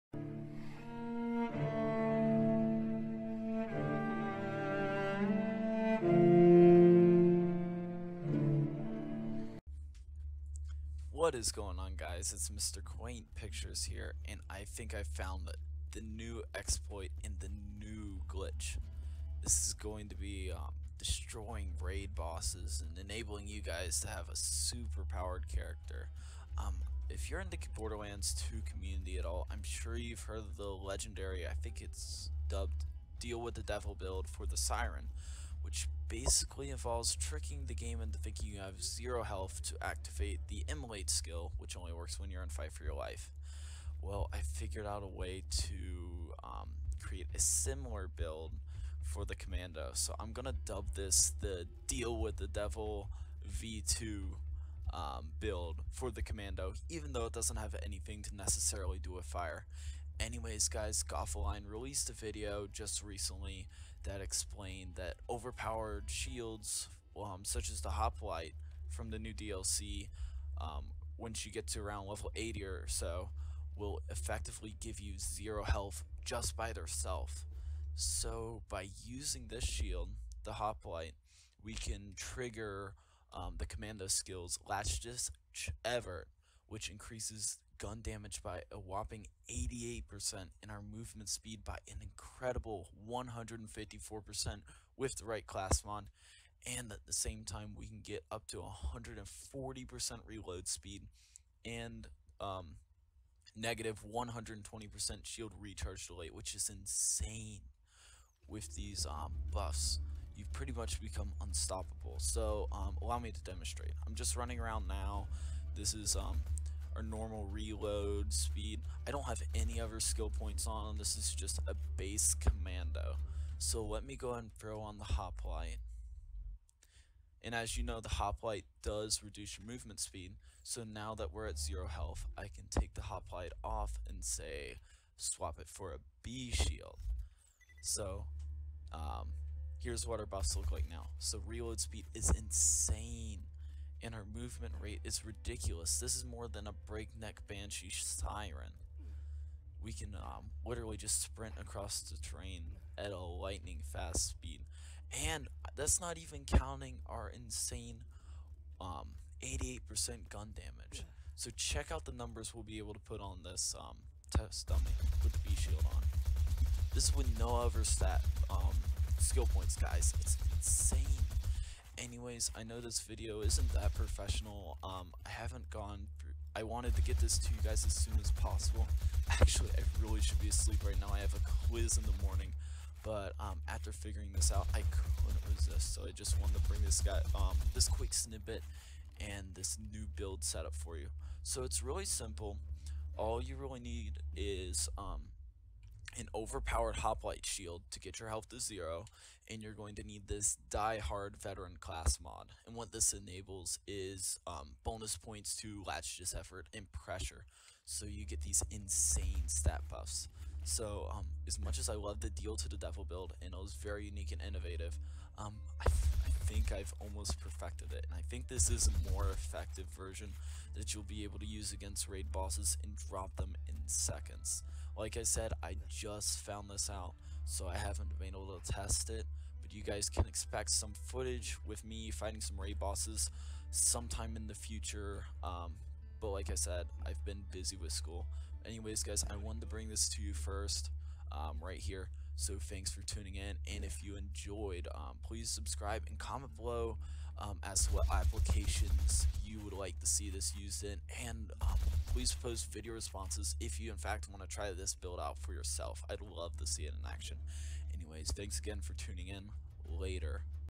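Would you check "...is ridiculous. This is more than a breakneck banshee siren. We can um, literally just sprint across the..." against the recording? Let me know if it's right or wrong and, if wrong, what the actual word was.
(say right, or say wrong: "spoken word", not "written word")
right.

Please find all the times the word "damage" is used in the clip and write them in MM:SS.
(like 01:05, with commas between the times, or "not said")
01:28, 02:40.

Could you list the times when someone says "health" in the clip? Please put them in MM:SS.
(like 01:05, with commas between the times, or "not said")
00:39, 01:15, 02:11, 03:18.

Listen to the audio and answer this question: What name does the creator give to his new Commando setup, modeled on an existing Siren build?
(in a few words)
Deal with the Devil V2.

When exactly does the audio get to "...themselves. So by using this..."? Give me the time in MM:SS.
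01:16.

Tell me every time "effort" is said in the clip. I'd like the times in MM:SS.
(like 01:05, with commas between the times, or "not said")
01:25, 03:26.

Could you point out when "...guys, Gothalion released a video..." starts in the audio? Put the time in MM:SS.
01:00.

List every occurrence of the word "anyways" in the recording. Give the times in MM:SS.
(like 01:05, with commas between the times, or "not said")
01:00, 02:52, 03:58, 04:17.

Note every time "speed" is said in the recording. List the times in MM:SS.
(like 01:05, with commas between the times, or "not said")
01:31, 01:40, 01:58, 02:09, 02:21, 02:34.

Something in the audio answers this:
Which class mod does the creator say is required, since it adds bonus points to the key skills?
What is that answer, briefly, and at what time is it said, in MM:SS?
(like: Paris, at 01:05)
Die Hard Veteran, at 03:20.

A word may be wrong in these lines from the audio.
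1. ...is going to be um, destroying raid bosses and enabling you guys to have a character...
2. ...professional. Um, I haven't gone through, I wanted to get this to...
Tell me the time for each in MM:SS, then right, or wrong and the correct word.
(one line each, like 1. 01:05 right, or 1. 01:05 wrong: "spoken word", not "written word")
1. 00:19 wrong: "super", not "character"
2. 02:53 right.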